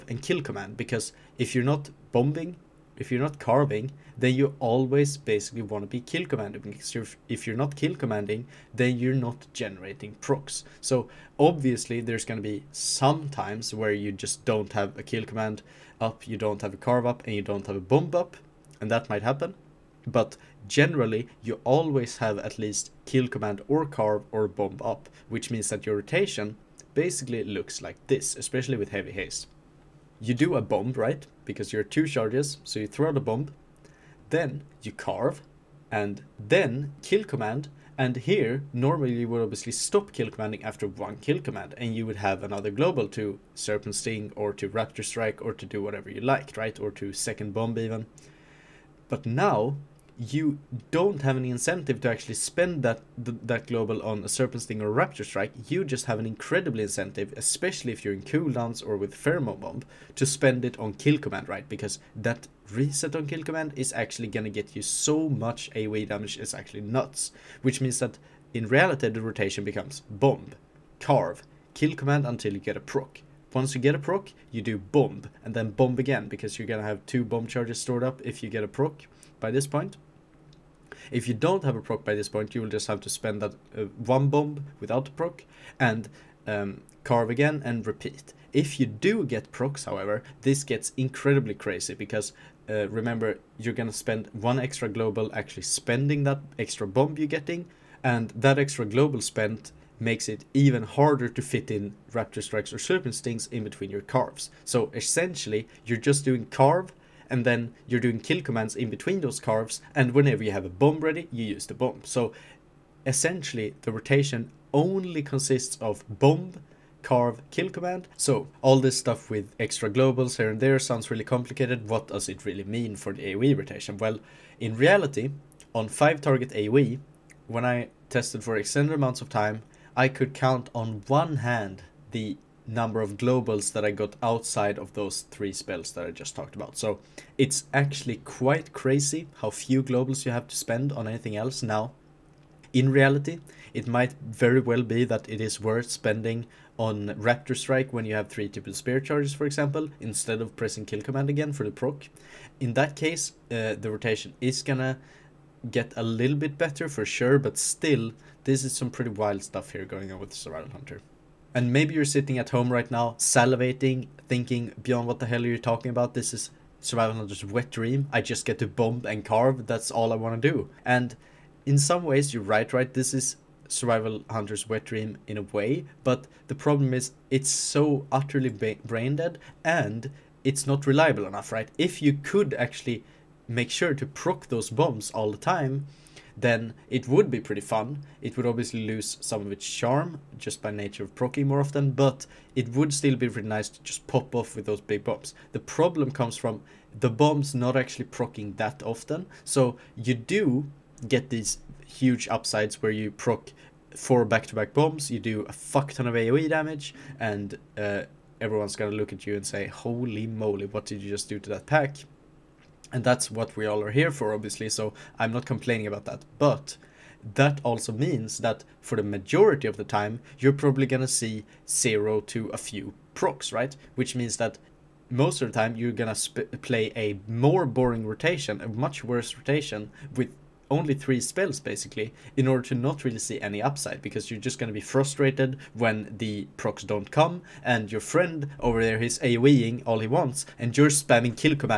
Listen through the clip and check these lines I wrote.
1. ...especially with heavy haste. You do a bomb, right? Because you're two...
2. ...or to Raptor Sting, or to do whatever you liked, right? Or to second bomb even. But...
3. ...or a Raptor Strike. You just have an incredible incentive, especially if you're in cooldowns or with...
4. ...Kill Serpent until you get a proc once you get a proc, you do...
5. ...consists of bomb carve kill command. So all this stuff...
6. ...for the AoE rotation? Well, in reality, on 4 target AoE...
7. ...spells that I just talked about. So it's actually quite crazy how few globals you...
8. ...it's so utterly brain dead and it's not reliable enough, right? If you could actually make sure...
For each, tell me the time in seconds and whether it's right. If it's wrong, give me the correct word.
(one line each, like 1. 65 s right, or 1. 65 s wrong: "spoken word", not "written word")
1. 28 s right
2. 44 s wrong: "Strike", not "Sting"
3. 54 s right
4. 71 s wrong: "Command", not "Serpent"
5. 115 s right
6. 122 s wrong: "5", not "4"
7. 135 s right
8. 177 s right.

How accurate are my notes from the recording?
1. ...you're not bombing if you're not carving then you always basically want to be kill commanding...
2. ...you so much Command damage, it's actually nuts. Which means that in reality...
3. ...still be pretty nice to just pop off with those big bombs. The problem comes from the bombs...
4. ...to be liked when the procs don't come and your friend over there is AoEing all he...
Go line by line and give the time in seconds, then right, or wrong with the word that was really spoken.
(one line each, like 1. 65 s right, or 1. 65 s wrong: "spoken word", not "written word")
1. 1 s right
2. 64 s wrong: "AoE", not "Command"
3. 192 s right
4. 234 s wrong: "frustrated", not "liked".